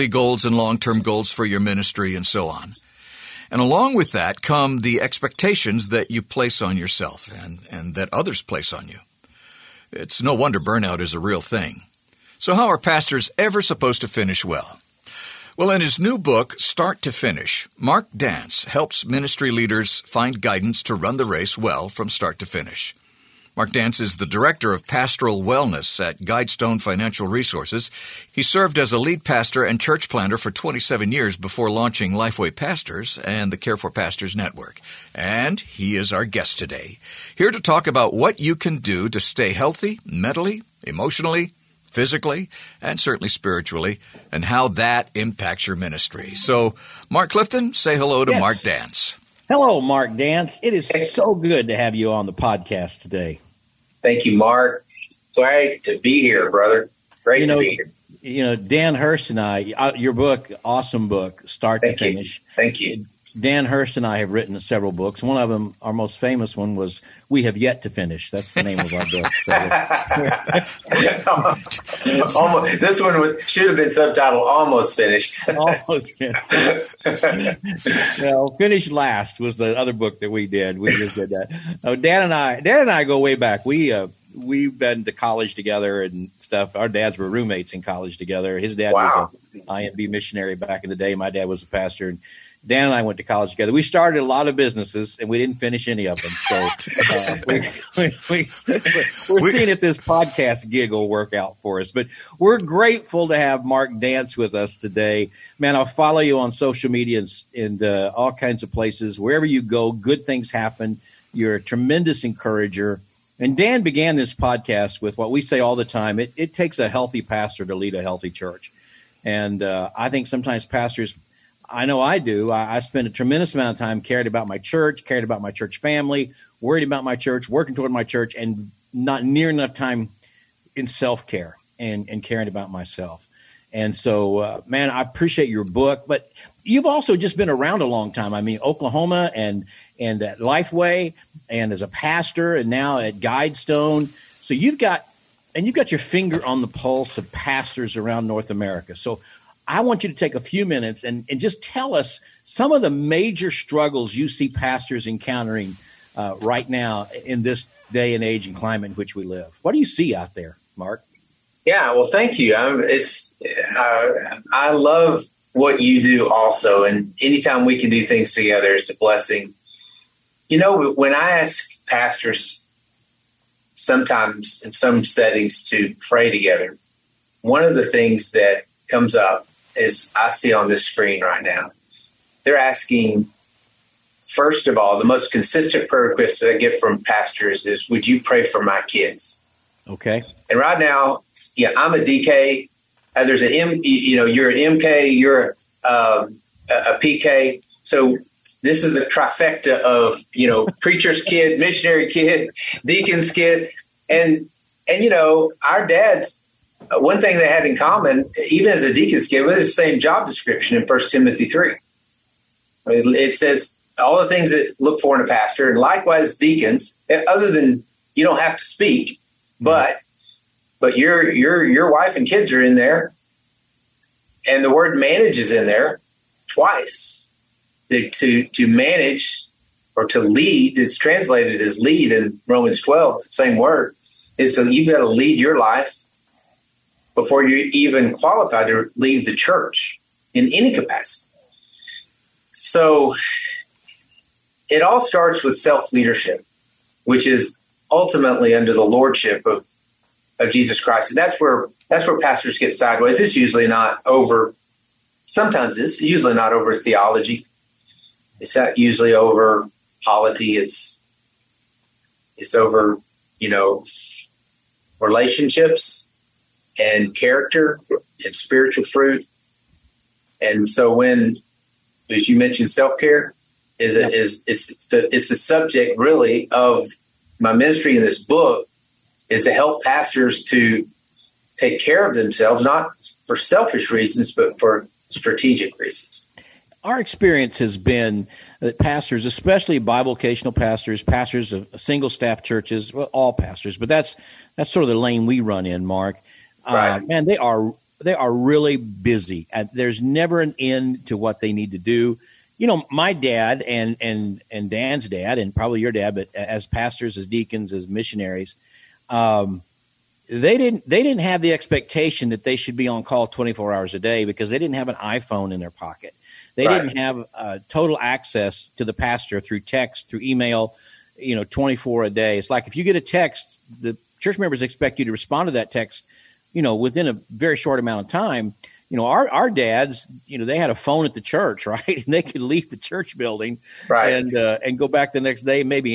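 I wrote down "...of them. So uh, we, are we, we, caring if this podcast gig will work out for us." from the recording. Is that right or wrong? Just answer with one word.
wrong.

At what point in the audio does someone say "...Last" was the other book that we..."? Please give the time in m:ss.
1:18.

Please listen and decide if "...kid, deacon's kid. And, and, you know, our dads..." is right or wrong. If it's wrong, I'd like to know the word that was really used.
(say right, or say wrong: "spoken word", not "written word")
right.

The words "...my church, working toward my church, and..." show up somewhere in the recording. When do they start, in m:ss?
2:07.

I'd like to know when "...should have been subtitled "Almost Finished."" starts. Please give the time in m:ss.
1:13.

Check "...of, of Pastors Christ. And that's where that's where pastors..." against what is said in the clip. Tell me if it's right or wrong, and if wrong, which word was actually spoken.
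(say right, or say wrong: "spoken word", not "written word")
wrong: "Jesus", not "Pastors".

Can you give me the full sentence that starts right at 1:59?
And uh, I think sometimes pastors I know I do.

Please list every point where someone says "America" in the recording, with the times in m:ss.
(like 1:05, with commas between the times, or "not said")
2:28.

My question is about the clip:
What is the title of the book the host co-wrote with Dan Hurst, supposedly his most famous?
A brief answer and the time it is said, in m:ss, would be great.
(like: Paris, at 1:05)
We Have Yet to Finish, at 1:07.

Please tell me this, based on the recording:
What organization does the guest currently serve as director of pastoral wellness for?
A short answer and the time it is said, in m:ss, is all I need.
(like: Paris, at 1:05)
Guidestone Financial Resources, at 0:26.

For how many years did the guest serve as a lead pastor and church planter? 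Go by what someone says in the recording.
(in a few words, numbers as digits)
27.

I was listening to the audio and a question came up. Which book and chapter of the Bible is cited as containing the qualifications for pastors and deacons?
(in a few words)
First Timothy 3.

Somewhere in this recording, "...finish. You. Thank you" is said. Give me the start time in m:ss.
1:02.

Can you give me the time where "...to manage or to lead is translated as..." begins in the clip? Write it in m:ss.
3:48.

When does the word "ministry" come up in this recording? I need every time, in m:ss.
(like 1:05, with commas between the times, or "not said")
0:01, 0:19, 0:45, 4:37.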